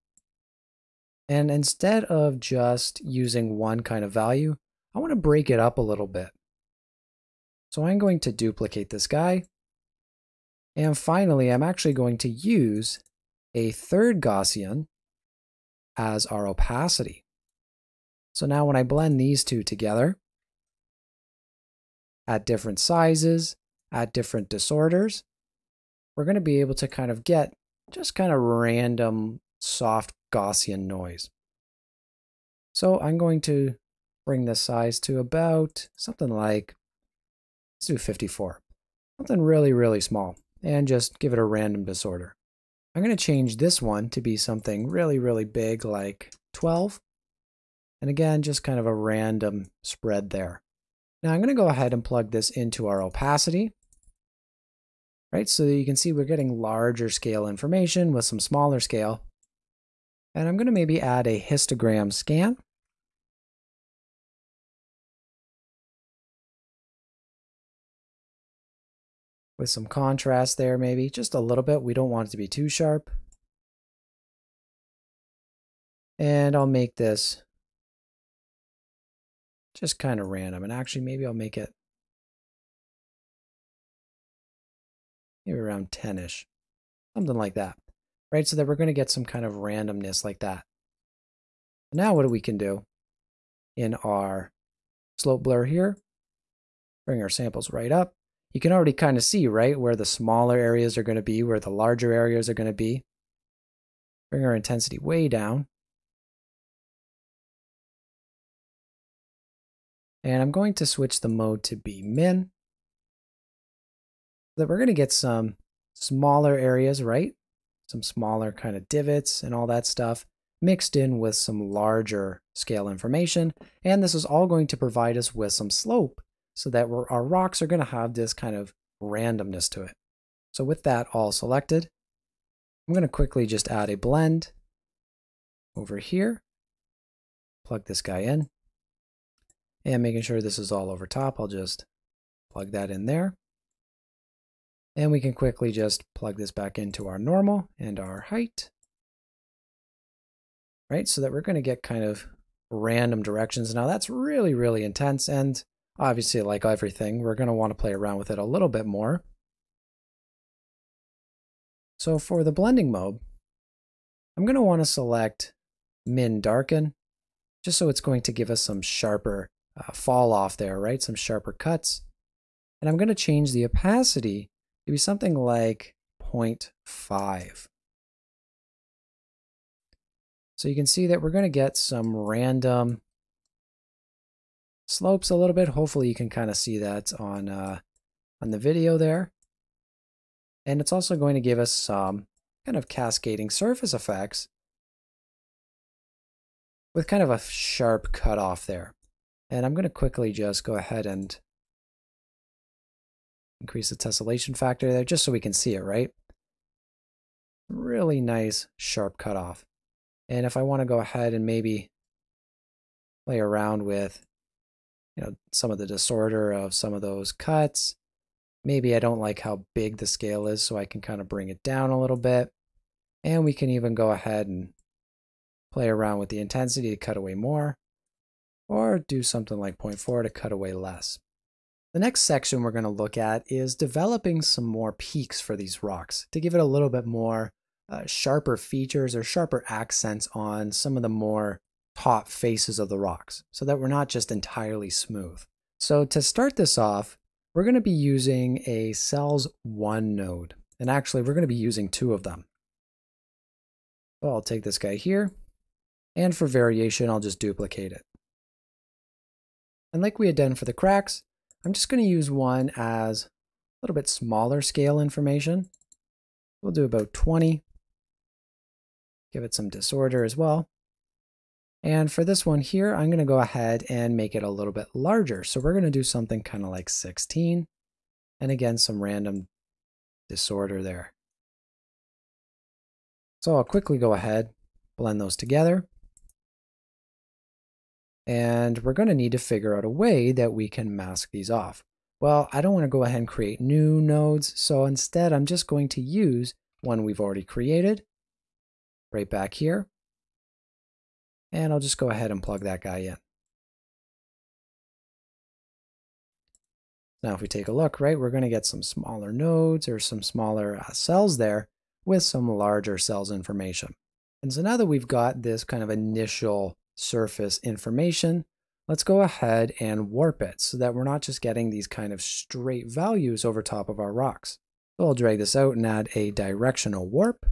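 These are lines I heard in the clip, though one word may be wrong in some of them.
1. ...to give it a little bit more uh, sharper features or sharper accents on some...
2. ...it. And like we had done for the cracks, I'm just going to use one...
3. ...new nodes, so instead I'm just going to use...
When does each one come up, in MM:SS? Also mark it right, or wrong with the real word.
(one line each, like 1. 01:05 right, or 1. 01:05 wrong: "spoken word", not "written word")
1. 03:56 right
2. 04:17 right
3. 04:53 right.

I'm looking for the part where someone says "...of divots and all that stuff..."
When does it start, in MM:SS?
01:58.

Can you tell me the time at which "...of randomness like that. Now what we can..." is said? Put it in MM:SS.
01:29.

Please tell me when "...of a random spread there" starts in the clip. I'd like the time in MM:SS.
00:48.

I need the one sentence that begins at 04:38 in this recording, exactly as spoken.
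And again, some random disorder there.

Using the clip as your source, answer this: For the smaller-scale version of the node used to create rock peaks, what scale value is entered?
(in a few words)
20.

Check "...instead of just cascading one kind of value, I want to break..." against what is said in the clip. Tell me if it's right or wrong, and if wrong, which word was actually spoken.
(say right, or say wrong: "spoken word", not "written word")
wrong: "using", not "cascading".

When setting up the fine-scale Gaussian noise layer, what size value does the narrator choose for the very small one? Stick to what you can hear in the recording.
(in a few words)
54.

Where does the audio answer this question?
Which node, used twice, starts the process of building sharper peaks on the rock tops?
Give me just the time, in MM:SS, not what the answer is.
04:08.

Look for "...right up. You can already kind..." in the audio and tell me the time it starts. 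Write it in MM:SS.
01:37.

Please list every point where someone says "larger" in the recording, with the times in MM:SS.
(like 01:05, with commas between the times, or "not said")
00:56, 01:41, 02:01, 04:34, 05:12.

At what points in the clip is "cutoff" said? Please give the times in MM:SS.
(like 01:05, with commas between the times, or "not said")
03:18, 03:29.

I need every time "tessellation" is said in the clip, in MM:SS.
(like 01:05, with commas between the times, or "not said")
03:23.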